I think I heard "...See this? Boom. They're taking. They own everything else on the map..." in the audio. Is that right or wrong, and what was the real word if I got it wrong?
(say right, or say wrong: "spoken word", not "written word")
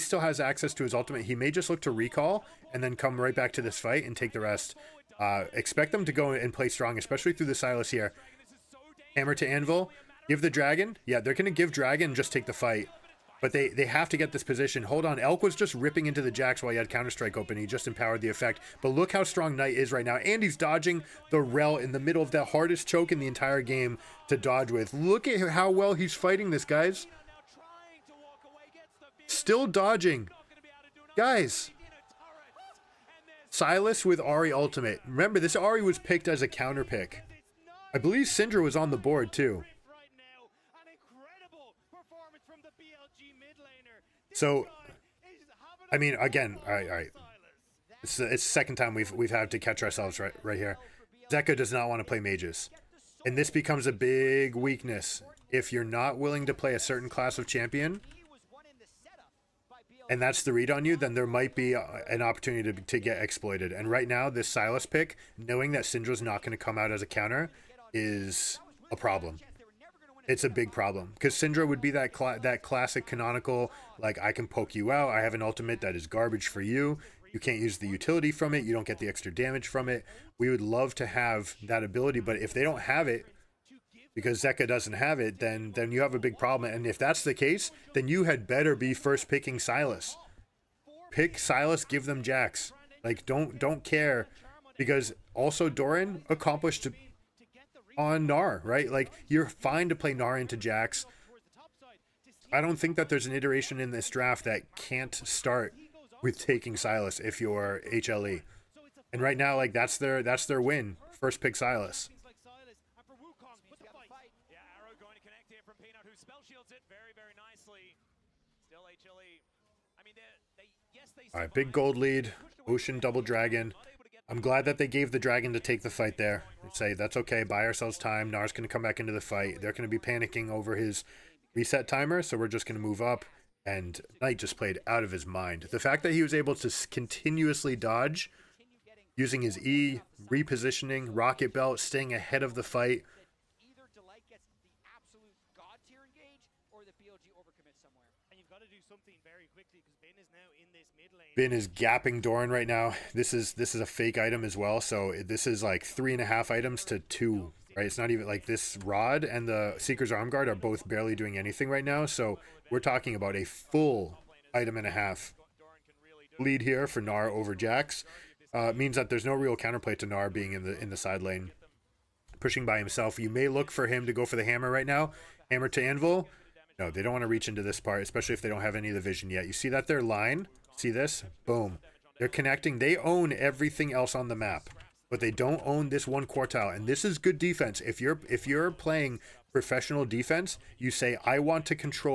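wrong: "connecting", not "taking".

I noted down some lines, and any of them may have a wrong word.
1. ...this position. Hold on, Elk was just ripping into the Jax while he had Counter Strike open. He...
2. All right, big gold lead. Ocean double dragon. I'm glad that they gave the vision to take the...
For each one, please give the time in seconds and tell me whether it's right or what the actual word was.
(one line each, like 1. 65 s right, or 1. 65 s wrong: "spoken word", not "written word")
1. 14 s right
2. 121 s wrong: "dragon", not "vision".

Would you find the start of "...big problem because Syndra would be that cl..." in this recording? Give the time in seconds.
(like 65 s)
70 s.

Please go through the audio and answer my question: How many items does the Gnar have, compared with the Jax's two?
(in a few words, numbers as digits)
3.5.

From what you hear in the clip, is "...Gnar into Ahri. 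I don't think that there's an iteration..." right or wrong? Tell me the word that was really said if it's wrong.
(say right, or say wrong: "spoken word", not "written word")
wrong: "Jax", not "Ahri".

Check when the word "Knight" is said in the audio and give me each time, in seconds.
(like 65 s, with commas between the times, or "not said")
19 s, 134 s.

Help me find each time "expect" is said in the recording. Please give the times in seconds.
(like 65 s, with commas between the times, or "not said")
5 s.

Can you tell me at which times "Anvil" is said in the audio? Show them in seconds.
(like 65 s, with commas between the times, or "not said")
9 s, 175 s.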